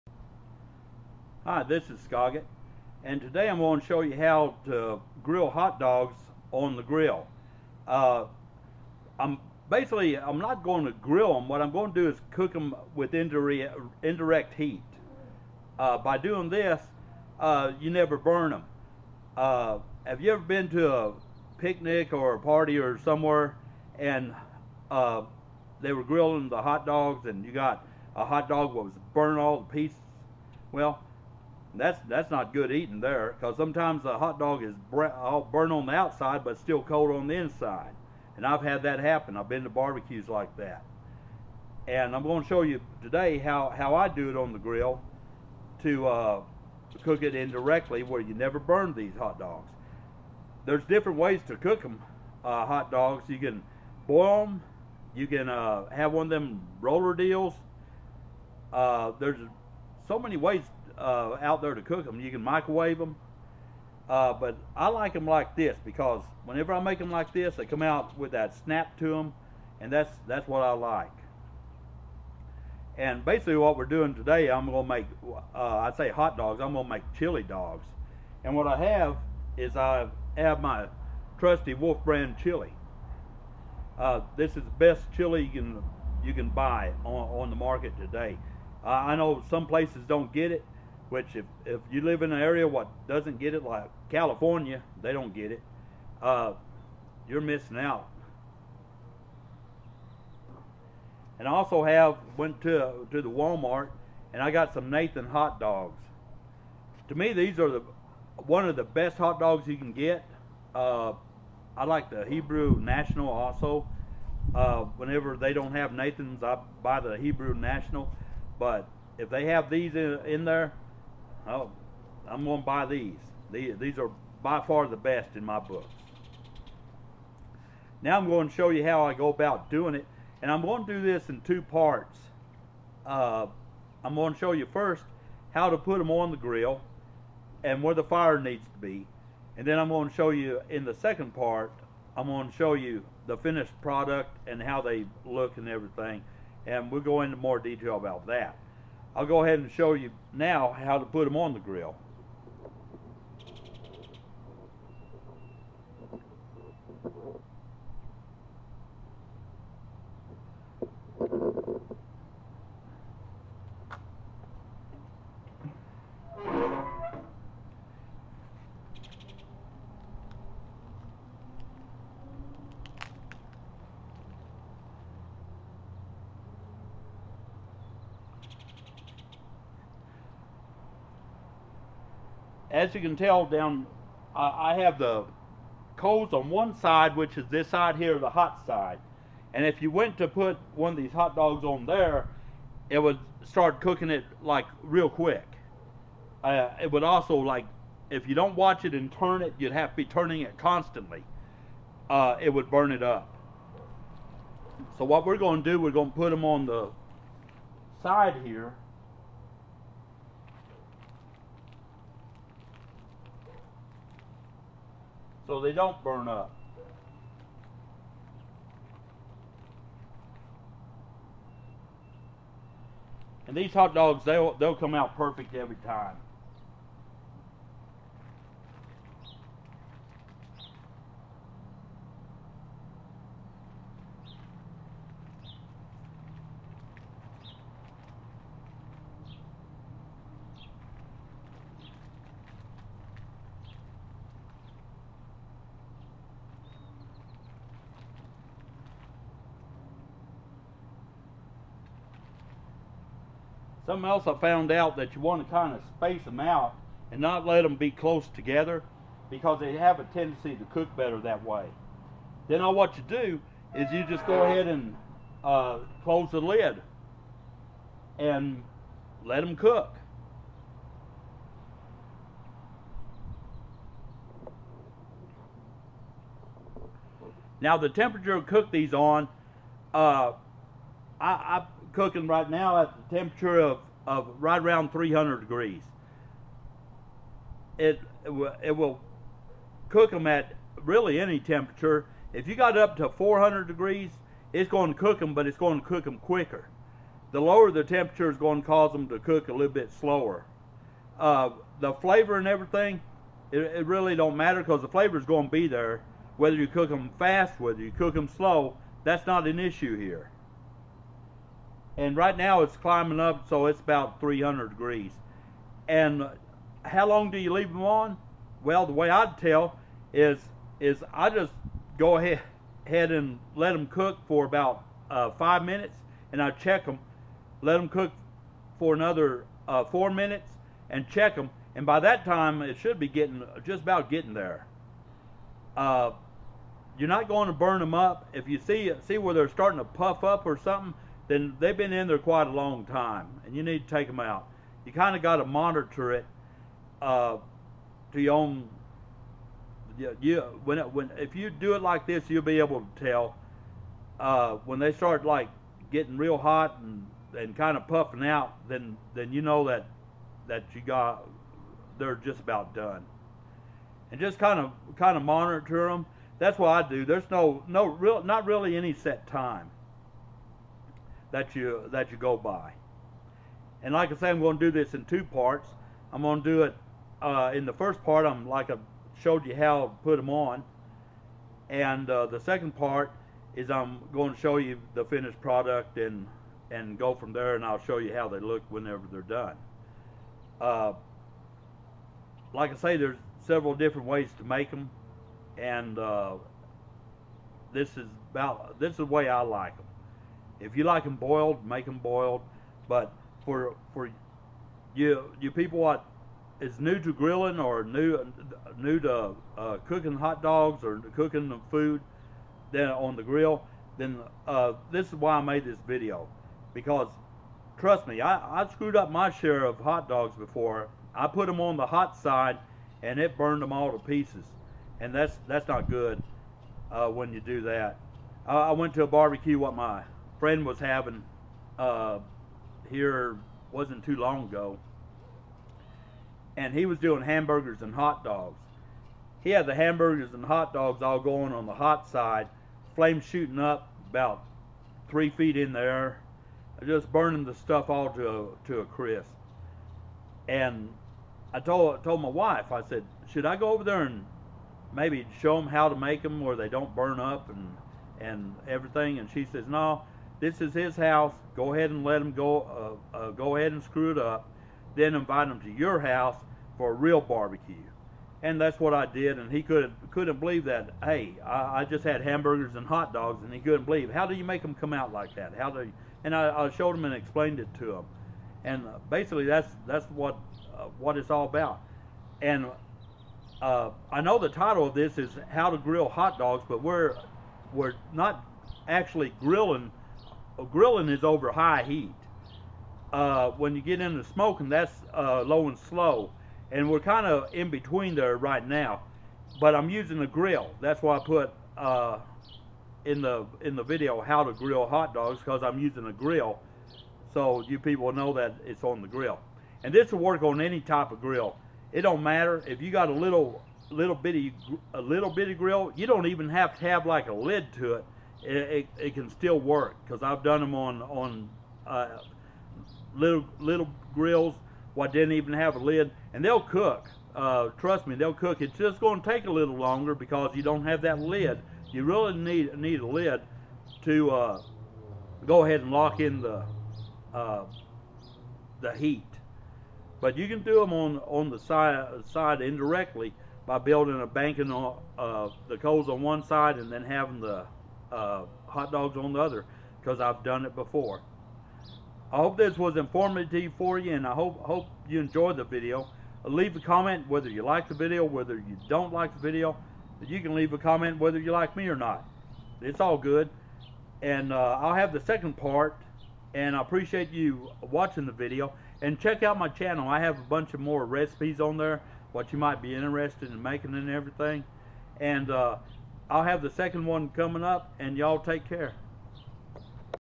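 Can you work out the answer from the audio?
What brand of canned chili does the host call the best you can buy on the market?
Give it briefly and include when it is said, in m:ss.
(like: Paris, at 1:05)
Wolf brand, at 1:21.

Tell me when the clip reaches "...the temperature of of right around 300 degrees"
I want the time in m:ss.
4:43.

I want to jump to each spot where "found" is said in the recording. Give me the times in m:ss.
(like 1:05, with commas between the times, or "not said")
4:14.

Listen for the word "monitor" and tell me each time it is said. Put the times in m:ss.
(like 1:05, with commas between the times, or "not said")
5:45, 6:05.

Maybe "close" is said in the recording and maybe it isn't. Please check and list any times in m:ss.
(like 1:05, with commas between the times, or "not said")
4:17, 4:26.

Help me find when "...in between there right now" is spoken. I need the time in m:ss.
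8:17.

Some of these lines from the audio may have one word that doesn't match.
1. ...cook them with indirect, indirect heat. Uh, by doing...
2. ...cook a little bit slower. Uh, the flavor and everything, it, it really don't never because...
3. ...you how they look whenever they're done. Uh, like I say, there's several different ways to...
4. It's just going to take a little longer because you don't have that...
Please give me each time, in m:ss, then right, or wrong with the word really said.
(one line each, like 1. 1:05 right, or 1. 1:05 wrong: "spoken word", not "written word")
1. 0:12 right
2. 4:59 wrong: "matter", not "never"
3. 6:27 right
4. 8:48 right.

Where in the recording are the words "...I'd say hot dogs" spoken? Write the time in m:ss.
1:15.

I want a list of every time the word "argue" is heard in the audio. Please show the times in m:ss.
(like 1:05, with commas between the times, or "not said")
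not said.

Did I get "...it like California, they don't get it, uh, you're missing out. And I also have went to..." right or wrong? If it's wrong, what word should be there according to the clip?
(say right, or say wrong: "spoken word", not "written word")
right.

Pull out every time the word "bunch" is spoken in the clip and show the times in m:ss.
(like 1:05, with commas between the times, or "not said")
9:30.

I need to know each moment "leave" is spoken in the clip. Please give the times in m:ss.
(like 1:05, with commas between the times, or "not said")
5:17, 9:16, 9:20.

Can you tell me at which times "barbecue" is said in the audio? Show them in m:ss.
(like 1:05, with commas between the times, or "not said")
0:39, 7:09, 7:47.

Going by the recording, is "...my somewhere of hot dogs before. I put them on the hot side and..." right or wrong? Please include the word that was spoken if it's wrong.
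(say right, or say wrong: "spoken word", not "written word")
wrong: "share", not "somewhere".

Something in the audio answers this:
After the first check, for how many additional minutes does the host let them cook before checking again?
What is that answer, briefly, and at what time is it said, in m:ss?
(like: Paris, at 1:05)
4, at 5:29.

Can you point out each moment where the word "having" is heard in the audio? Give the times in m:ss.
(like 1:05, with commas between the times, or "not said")
7:10, 9:07.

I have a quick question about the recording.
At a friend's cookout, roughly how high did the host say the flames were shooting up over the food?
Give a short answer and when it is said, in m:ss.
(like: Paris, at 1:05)
3 feet, at 7:25.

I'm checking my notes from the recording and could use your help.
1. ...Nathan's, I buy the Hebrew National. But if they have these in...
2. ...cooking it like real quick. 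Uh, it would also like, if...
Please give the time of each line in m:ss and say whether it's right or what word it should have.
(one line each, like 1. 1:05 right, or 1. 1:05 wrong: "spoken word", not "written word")
1. 1:55 right
2. 3:13 right.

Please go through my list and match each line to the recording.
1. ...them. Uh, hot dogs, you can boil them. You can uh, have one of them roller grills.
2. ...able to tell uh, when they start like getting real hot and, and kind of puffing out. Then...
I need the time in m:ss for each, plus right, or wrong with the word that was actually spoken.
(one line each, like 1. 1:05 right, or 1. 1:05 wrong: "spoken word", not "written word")
1. 0:51 wrong: "deals", not "grills"
2. 5:52 right.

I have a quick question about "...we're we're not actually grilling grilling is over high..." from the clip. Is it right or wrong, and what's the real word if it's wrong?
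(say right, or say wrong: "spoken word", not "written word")
right.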